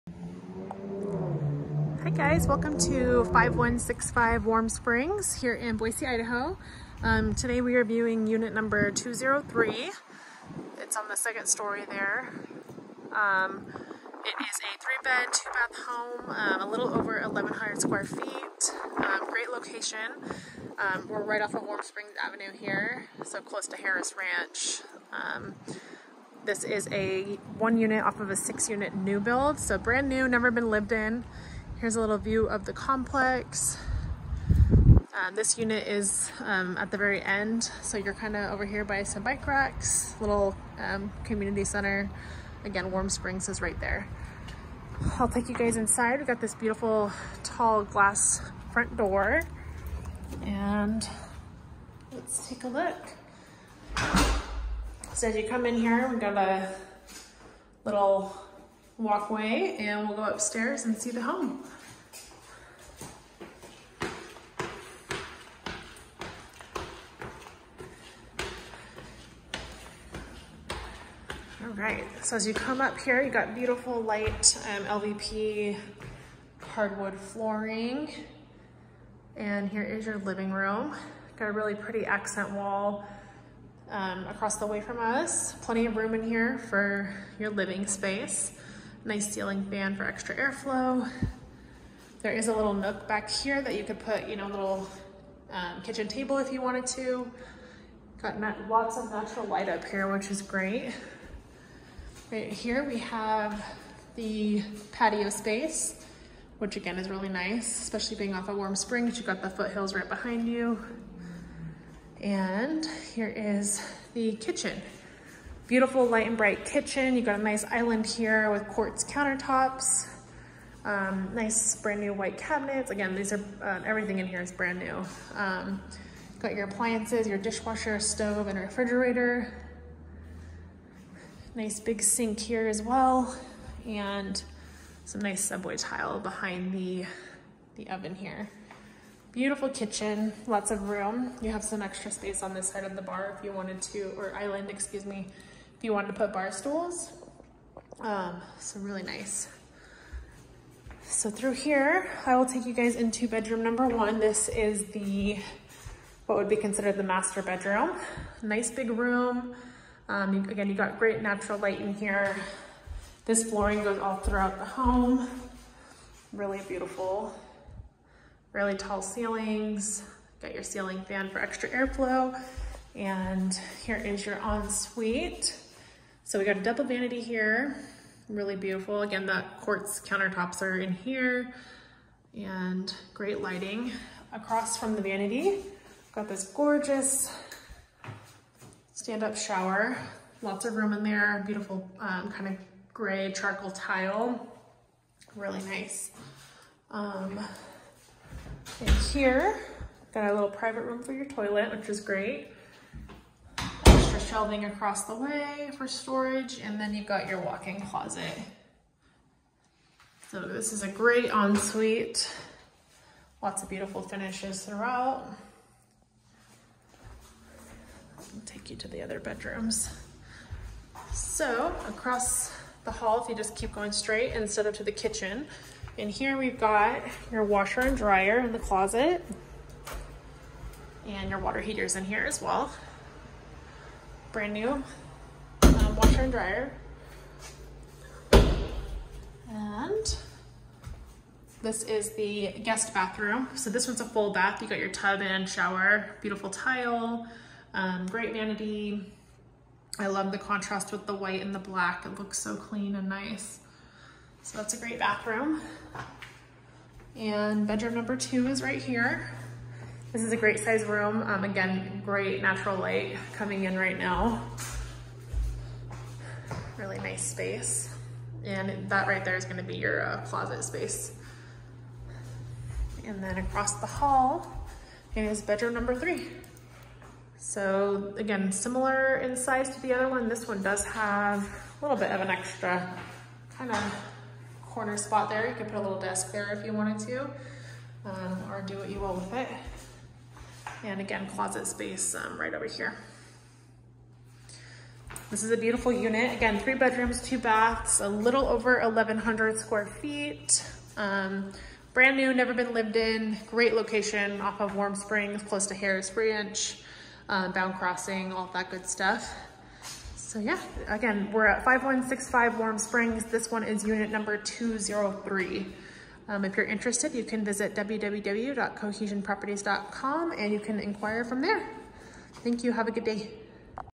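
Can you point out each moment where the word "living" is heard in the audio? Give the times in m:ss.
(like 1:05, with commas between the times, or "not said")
1:20, 1:27.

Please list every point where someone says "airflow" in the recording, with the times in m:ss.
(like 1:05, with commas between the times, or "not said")
1:30, 2:51.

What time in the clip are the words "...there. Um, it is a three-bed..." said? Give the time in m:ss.
0:11.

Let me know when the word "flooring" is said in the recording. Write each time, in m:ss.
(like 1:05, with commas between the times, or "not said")
1:17, 2:43.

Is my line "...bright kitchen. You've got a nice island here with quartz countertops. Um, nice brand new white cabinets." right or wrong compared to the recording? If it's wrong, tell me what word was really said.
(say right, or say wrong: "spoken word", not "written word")
right.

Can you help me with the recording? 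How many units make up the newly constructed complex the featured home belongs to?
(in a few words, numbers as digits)
6.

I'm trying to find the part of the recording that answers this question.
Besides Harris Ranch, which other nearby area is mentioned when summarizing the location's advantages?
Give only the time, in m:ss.
5:07.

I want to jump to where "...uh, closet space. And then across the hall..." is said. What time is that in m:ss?
4:30.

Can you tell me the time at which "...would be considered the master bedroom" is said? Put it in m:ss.
2:36.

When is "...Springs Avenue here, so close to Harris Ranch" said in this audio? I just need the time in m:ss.
0:21.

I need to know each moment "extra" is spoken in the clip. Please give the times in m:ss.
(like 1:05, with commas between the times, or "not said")
1:30, 2:21, 2:51, 4:42.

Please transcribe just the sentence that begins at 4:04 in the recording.
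You got your tub and shower, beautiful tile, um, great vanity.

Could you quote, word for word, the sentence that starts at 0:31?
Here's a little view of the complex.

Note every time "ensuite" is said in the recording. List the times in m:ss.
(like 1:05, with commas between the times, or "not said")
2:54, 3:31.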